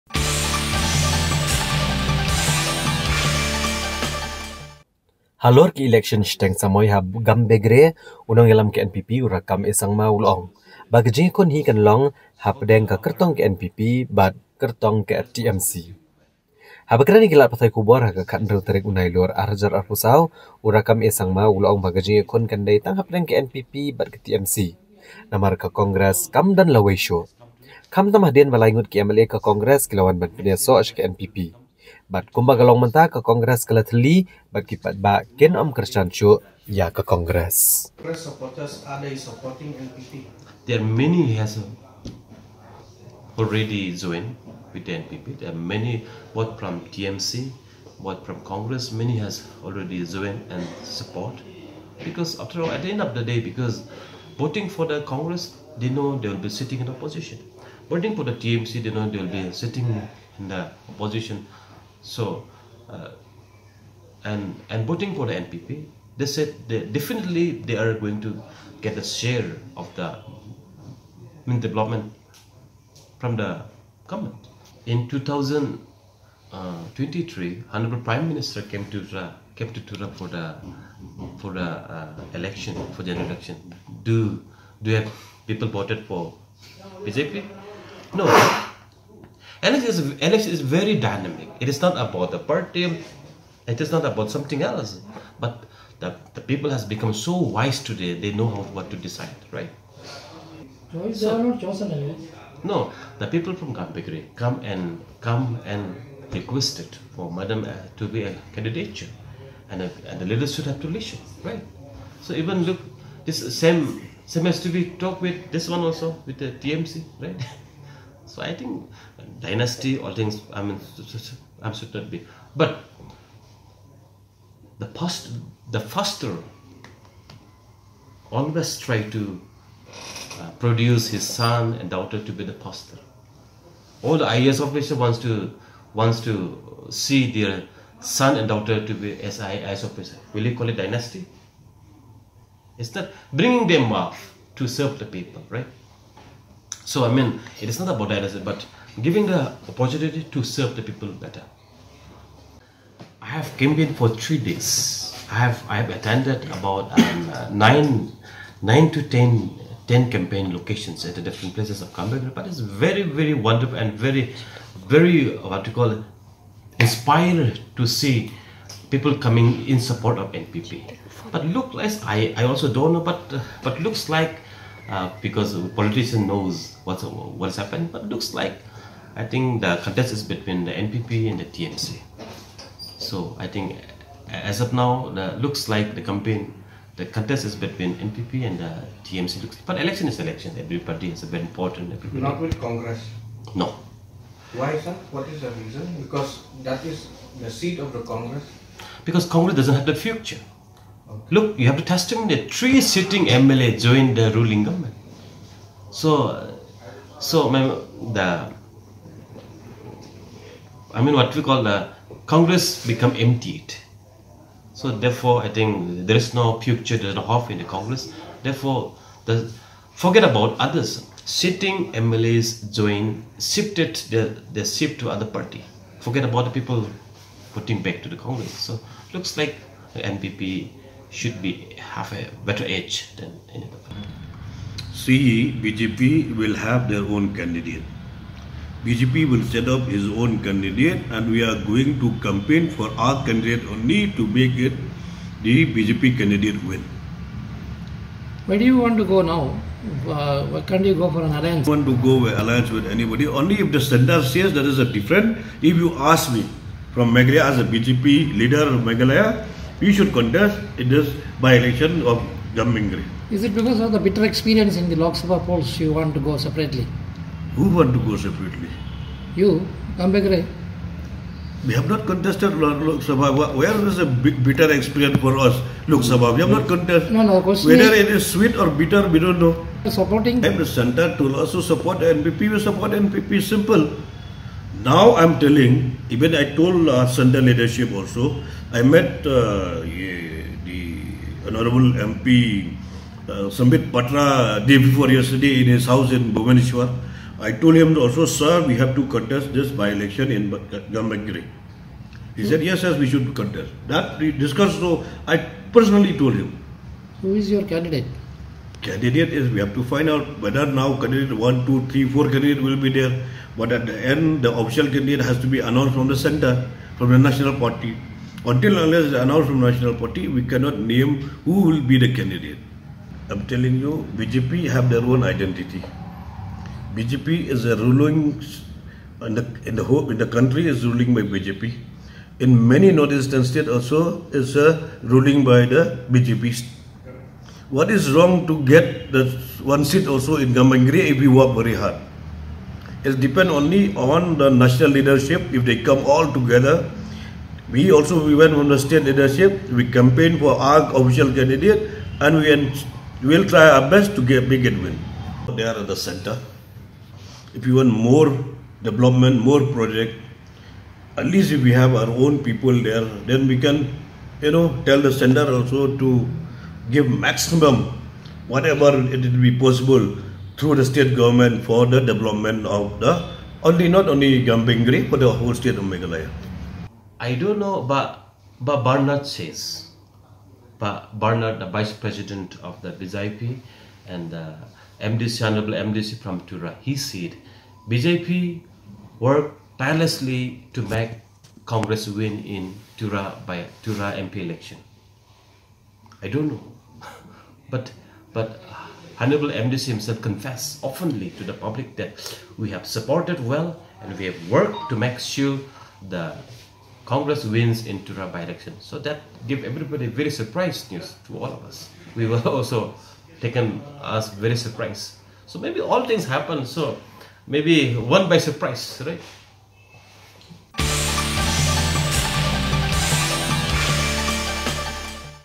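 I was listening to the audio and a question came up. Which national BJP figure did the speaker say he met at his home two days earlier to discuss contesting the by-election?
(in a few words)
Sambit Patra.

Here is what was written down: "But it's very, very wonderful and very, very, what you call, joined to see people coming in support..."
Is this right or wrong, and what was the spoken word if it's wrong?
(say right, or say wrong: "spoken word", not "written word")
wrong: "inspired", not "joined".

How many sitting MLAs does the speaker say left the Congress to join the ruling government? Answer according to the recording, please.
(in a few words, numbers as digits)
3.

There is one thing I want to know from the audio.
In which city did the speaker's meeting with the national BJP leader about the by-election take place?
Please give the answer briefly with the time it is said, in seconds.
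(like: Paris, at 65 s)
Bhubaneswar, at 296 s.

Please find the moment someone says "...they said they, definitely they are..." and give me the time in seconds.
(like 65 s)
66 s.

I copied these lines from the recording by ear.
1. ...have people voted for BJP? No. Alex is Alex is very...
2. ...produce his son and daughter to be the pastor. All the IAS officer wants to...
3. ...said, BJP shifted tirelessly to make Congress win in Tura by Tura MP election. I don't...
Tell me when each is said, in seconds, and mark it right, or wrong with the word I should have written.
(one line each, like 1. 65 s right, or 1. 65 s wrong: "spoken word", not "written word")
1. 85 s right
2. 130 s right
3. 386 s wrong: "worked", not "shifted".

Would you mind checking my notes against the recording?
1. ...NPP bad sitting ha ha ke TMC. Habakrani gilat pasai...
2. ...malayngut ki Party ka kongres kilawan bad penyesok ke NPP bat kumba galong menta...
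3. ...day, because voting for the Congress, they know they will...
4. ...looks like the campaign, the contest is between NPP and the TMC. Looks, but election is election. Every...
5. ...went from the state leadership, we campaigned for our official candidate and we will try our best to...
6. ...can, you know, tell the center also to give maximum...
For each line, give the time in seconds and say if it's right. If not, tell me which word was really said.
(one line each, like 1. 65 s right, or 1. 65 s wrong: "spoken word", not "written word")
1. 13 s wrong: "kertong", not "sitting"
2. 28 s wrong: "MLA", not "Party"
3. 53 s right
4. 185 s right
5. 348 s right
6. 363 s right.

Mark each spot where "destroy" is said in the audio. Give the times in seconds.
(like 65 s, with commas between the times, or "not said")
not said.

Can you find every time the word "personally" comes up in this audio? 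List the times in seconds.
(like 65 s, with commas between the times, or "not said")
305 s.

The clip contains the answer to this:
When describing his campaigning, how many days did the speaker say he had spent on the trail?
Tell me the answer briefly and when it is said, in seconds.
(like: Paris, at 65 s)
3 days, at 154 s.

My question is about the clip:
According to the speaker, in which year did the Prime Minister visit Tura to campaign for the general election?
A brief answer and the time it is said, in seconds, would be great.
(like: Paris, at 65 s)
2023, at 74 s.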